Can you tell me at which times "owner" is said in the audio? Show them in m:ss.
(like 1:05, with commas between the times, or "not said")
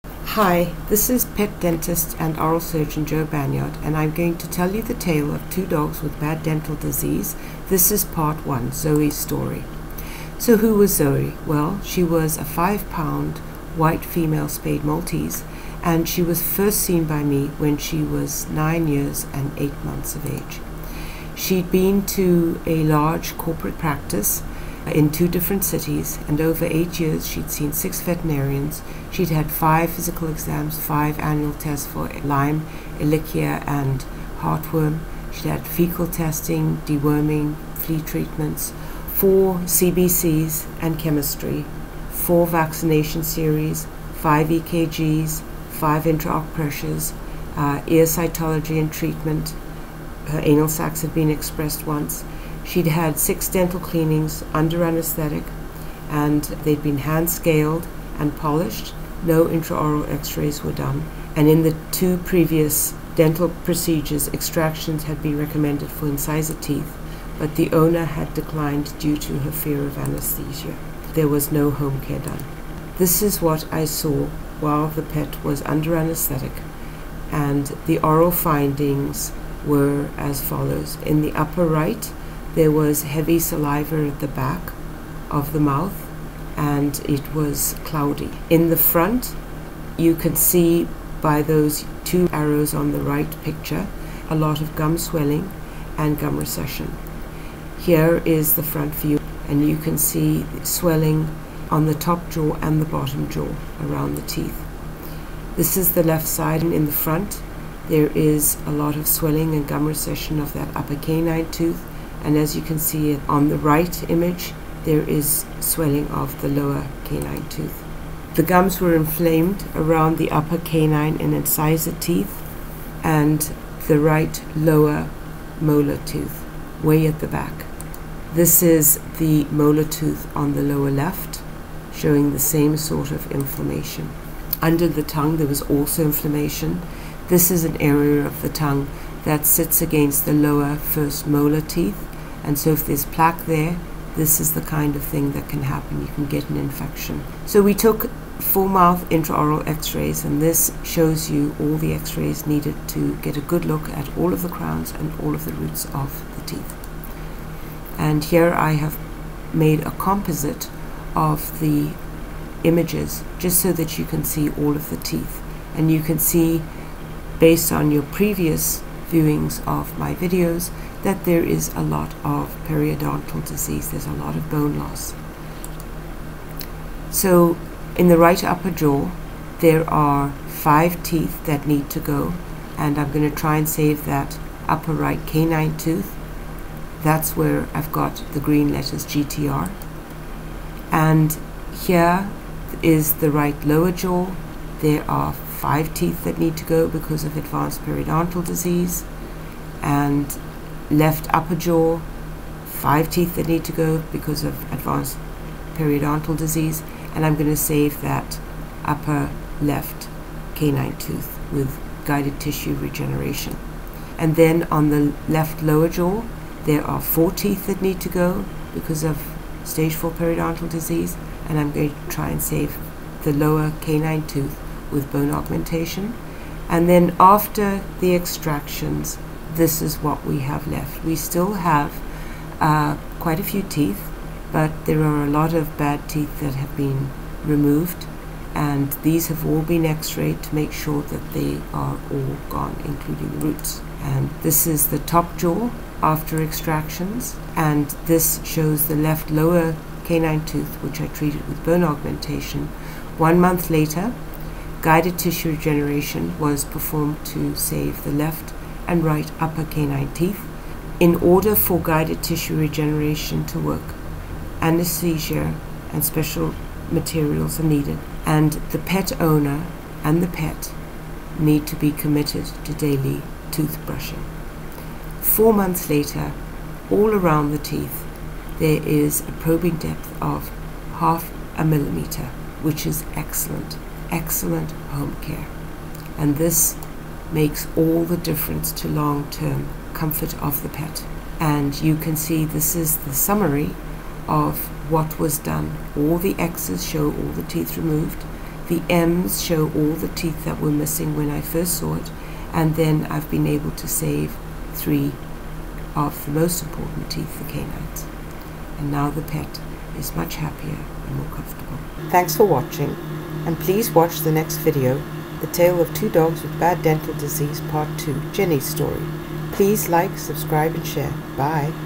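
1:07, 4:29.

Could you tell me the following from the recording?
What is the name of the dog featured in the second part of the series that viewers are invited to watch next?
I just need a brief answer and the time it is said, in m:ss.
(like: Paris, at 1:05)
Jenny, at 5:18.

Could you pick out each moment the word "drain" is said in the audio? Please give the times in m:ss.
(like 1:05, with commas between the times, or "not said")
not said.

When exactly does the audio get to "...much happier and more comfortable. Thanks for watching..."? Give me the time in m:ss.
5:10.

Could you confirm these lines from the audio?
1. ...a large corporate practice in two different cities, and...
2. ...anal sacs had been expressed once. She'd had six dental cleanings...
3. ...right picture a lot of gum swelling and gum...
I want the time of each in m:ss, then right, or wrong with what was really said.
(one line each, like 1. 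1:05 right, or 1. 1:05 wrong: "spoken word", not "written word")
1. 0:22 right
2. 0:50 right
3. 1:32 right.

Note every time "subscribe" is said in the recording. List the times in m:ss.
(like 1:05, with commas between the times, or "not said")
5:20.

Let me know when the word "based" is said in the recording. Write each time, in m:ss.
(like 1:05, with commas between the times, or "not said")
2:47.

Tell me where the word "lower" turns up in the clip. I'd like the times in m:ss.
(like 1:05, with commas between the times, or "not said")
1:56, 2:04, 2:10, 2:20, 3:13, 3:35, 3:43, 4:09.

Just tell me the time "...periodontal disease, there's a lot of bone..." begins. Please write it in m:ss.
2:52.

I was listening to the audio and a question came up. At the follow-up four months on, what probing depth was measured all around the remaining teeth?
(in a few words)
half a millimeter.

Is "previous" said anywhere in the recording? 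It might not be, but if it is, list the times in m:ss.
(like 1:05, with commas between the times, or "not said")
1:02, 2:48.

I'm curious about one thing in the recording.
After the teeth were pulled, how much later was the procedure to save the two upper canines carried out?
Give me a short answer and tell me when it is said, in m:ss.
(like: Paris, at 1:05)
1 month, at 4:13.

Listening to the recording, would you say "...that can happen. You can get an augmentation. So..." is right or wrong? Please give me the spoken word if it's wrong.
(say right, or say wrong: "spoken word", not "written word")
wrong: "infection", not "augmentation".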